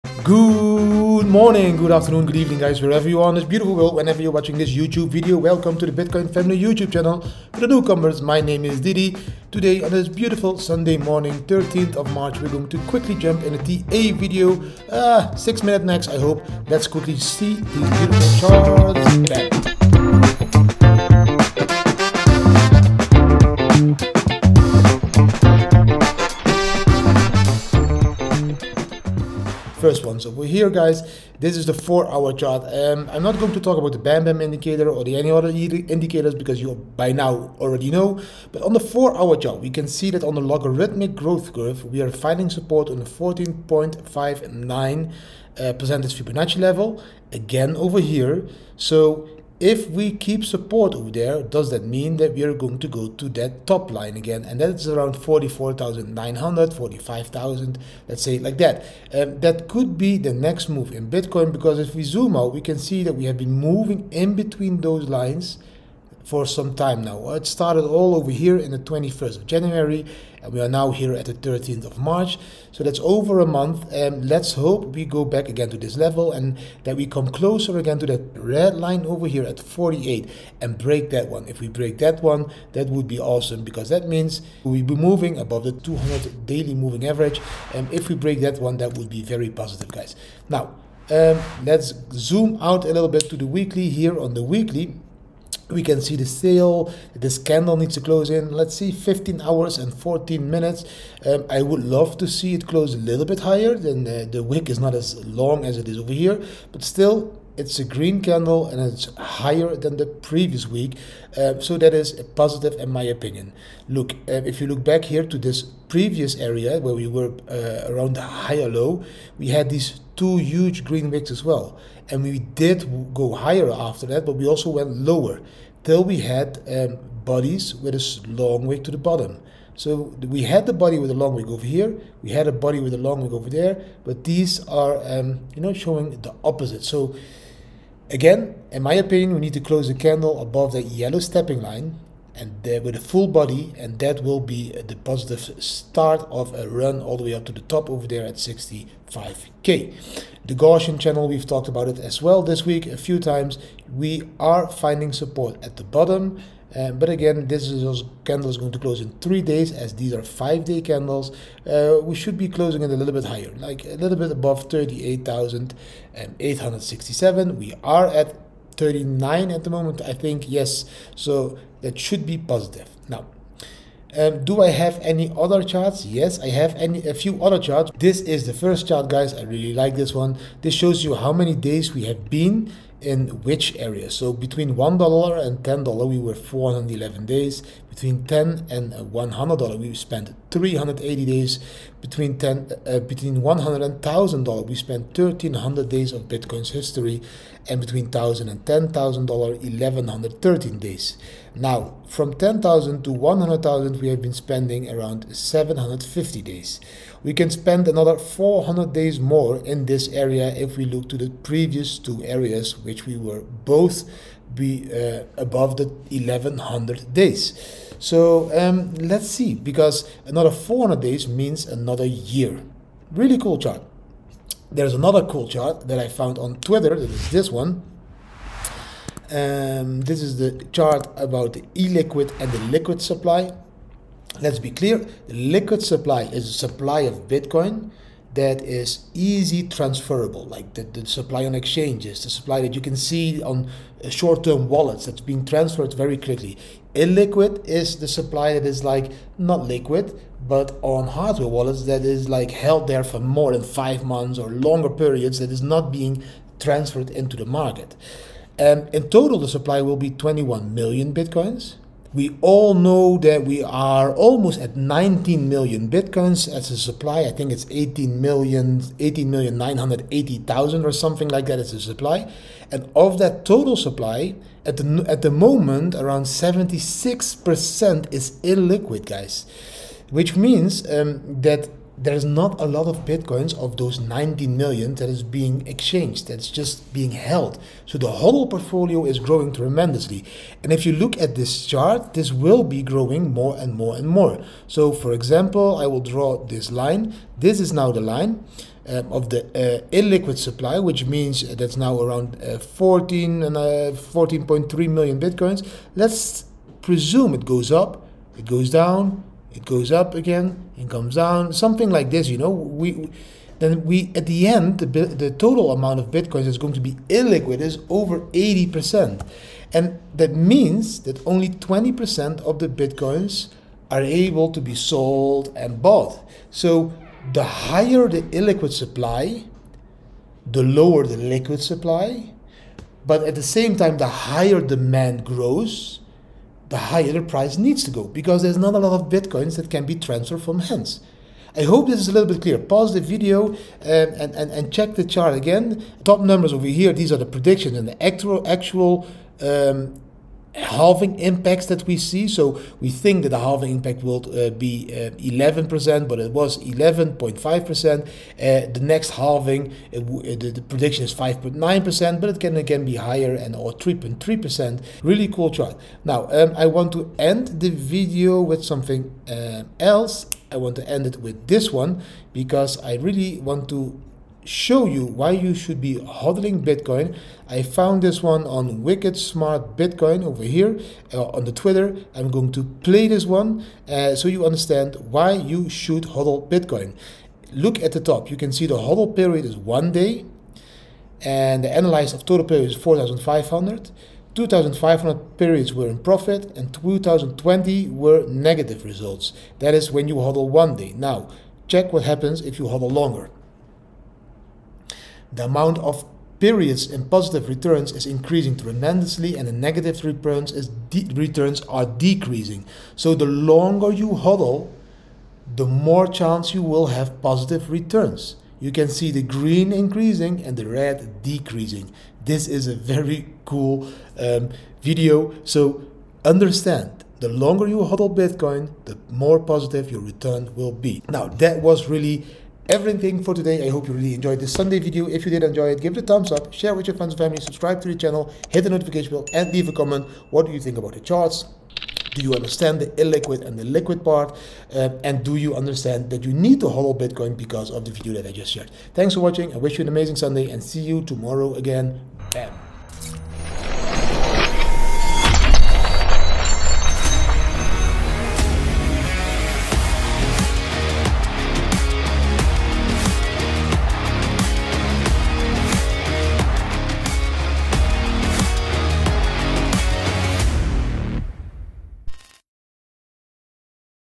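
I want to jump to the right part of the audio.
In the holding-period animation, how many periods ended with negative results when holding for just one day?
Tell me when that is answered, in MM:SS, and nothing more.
06:36.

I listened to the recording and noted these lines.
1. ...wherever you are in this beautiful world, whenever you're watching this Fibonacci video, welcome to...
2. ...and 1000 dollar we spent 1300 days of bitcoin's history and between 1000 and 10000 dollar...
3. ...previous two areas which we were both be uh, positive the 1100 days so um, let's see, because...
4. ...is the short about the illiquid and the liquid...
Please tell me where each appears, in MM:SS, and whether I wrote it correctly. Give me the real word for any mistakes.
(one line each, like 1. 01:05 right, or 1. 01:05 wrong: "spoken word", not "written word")
1. 00:02 wrong: "YouTube", not "Fibonacci"
2. 03:13 right
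3. 03:31 wrong: "above", not "positive"
4. 03:50 wrong: "chart", not "short".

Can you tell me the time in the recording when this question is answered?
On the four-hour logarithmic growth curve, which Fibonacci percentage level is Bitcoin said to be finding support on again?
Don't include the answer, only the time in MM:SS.
00:43.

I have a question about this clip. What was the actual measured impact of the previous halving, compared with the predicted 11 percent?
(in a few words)
11.5%.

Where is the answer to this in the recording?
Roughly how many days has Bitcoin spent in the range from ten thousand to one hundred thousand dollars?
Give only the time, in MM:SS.
03:25.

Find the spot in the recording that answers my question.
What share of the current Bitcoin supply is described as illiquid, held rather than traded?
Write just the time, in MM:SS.
04:36.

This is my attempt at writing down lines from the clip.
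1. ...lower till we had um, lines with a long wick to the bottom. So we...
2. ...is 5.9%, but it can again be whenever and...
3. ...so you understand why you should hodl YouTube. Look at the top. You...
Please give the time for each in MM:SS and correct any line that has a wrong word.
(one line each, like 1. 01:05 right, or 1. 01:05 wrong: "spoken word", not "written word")
1. 02:04 wrong: "bodies", not "lines"
2. 06:01 wrong: "higher", not "whenever"
3. 06:24 wrong: "Bitcoin", not "YouTube".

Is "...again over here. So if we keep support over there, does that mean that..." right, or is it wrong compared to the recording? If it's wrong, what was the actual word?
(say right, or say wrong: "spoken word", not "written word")
right.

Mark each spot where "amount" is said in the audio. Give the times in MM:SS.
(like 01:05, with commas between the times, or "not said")
05:15, 06:45.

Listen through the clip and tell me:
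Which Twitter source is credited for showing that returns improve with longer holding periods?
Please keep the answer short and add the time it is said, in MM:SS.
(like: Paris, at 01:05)
Wicked Smart Bitcoin, at 06:18.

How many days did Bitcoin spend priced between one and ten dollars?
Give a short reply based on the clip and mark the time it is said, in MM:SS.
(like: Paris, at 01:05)
411, at 03:06.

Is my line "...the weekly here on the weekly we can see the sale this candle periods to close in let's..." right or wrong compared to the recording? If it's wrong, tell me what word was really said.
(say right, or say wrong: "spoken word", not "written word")
wrong: "needs", not "periods".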